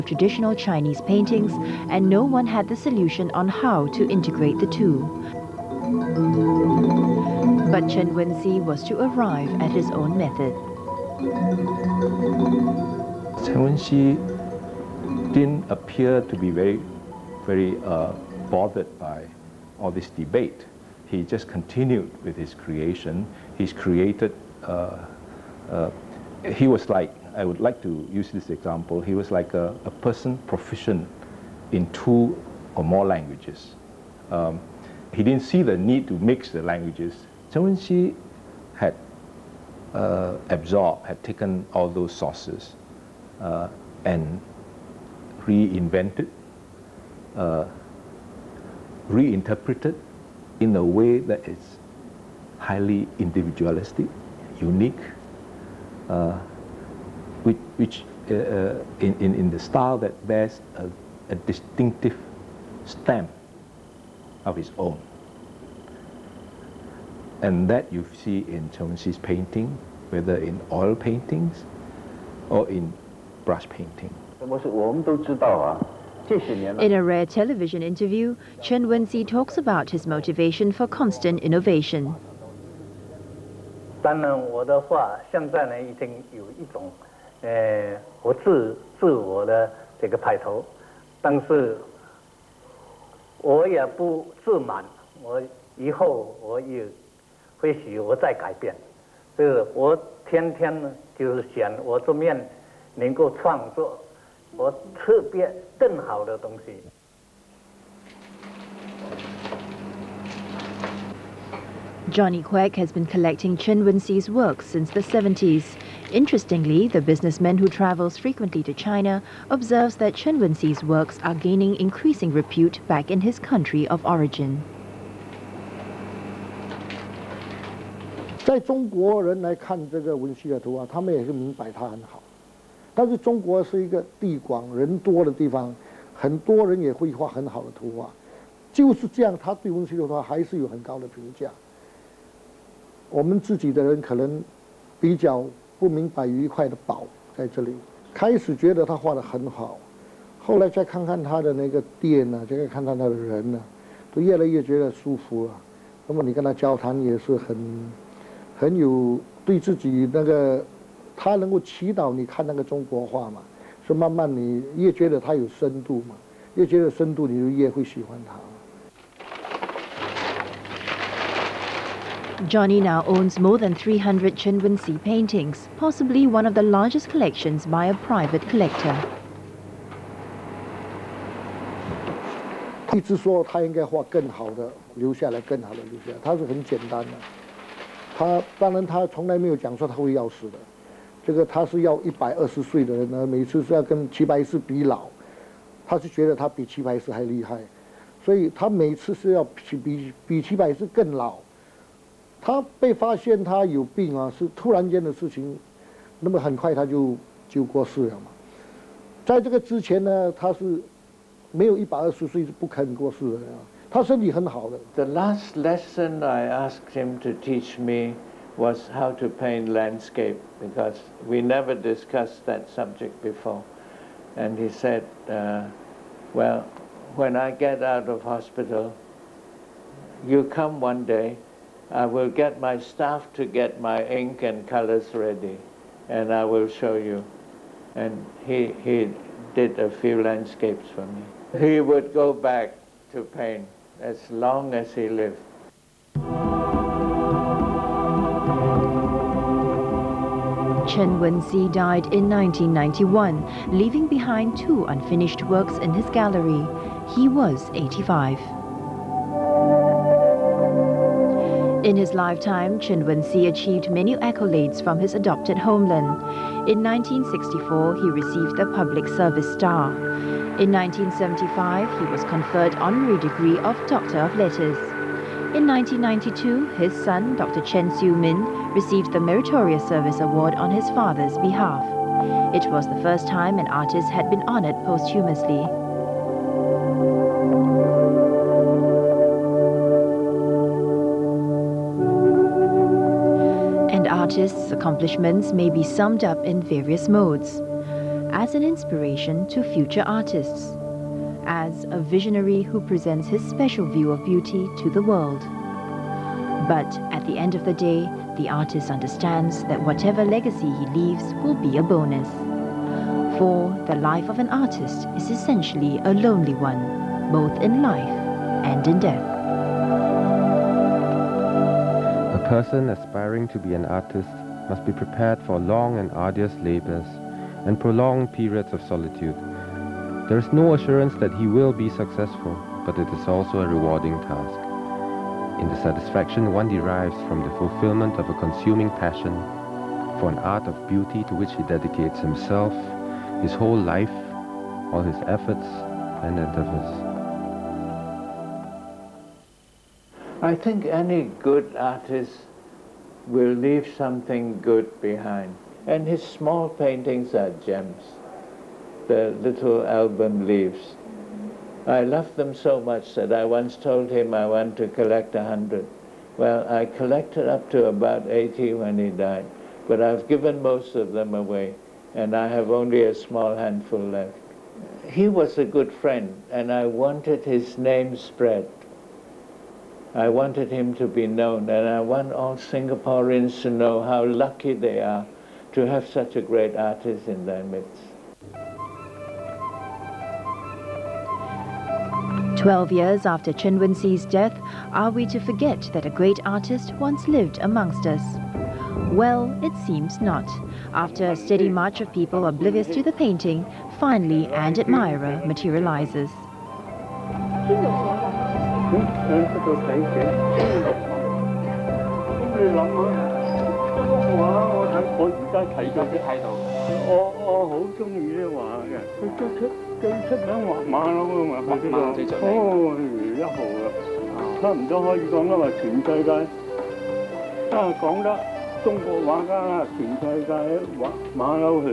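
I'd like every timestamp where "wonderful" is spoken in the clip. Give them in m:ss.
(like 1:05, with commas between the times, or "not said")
not said.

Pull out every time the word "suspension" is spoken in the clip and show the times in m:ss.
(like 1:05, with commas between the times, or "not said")
not said.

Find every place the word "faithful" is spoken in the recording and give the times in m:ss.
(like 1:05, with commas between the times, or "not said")
not said.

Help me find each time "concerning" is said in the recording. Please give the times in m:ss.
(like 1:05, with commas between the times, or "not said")
not said.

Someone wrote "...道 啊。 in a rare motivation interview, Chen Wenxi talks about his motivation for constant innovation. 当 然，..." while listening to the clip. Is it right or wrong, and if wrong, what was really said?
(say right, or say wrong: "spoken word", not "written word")
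wrong: "television", not "motivation".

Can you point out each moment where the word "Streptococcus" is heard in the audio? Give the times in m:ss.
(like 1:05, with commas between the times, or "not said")
not said.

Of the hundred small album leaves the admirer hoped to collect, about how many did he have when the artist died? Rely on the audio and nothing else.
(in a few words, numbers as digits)
80.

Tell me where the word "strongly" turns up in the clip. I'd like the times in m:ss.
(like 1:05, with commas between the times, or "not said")
not said.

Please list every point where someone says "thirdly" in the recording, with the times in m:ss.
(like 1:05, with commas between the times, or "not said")
not said.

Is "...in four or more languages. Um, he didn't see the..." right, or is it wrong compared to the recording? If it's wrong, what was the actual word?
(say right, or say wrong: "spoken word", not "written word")
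wrong: "two", not "four".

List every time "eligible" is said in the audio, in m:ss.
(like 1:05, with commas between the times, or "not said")
not said.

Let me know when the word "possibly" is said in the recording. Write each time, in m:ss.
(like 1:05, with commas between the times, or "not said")
2:55.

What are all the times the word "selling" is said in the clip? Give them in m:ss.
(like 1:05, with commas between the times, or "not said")
not said.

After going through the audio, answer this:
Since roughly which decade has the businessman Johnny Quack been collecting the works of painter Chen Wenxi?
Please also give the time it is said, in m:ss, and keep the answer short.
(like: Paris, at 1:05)
the 1970s, at 1:54.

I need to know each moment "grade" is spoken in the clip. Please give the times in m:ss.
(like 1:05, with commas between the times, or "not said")
not said.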